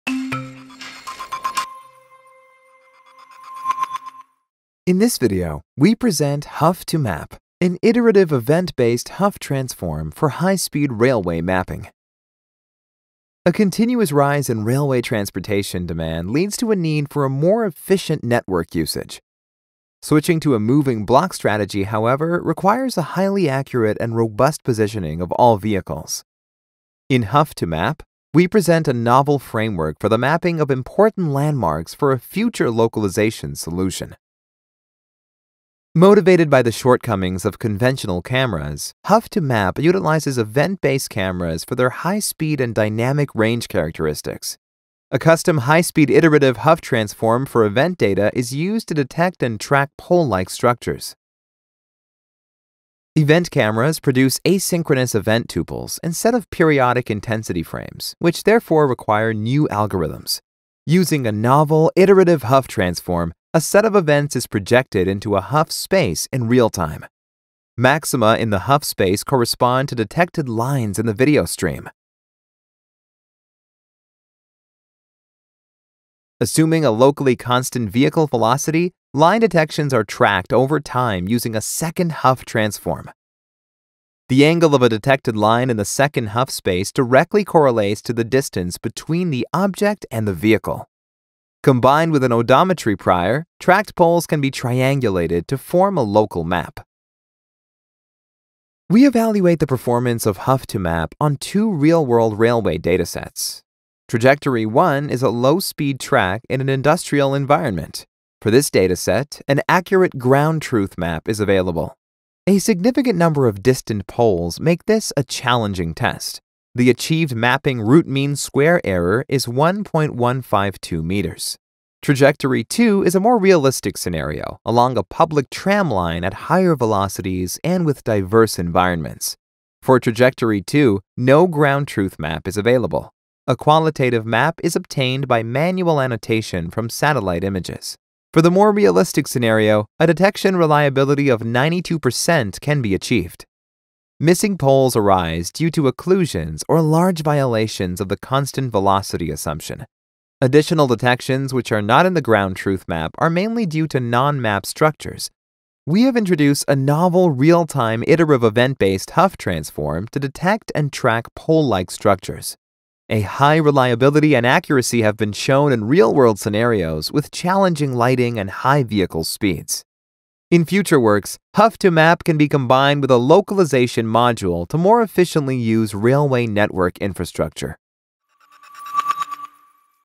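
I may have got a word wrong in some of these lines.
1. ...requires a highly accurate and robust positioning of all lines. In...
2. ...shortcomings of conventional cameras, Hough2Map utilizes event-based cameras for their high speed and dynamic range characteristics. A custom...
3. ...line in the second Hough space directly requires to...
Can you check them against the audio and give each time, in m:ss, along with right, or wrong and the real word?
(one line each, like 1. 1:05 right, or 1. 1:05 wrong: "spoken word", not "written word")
1. 0:22 wrong: "vehicles", not "lines"
2. 0:36 right
3. 1:25 wrong: "correlates", not "requires".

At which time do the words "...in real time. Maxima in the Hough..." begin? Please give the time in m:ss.
1:06.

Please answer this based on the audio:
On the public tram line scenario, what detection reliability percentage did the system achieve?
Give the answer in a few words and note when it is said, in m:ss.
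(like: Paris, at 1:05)
92%, at 2:21.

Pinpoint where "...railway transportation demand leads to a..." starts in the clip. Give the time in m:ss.
0:14.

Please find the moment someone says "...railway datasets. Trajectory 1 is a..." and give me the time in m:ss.
1:42.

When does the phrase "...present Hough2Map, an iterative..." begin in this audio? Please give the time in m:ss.
0:05.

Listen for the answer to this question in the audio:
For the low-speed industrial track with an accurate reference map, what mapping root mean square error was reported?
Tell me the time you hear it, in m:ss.
1:59.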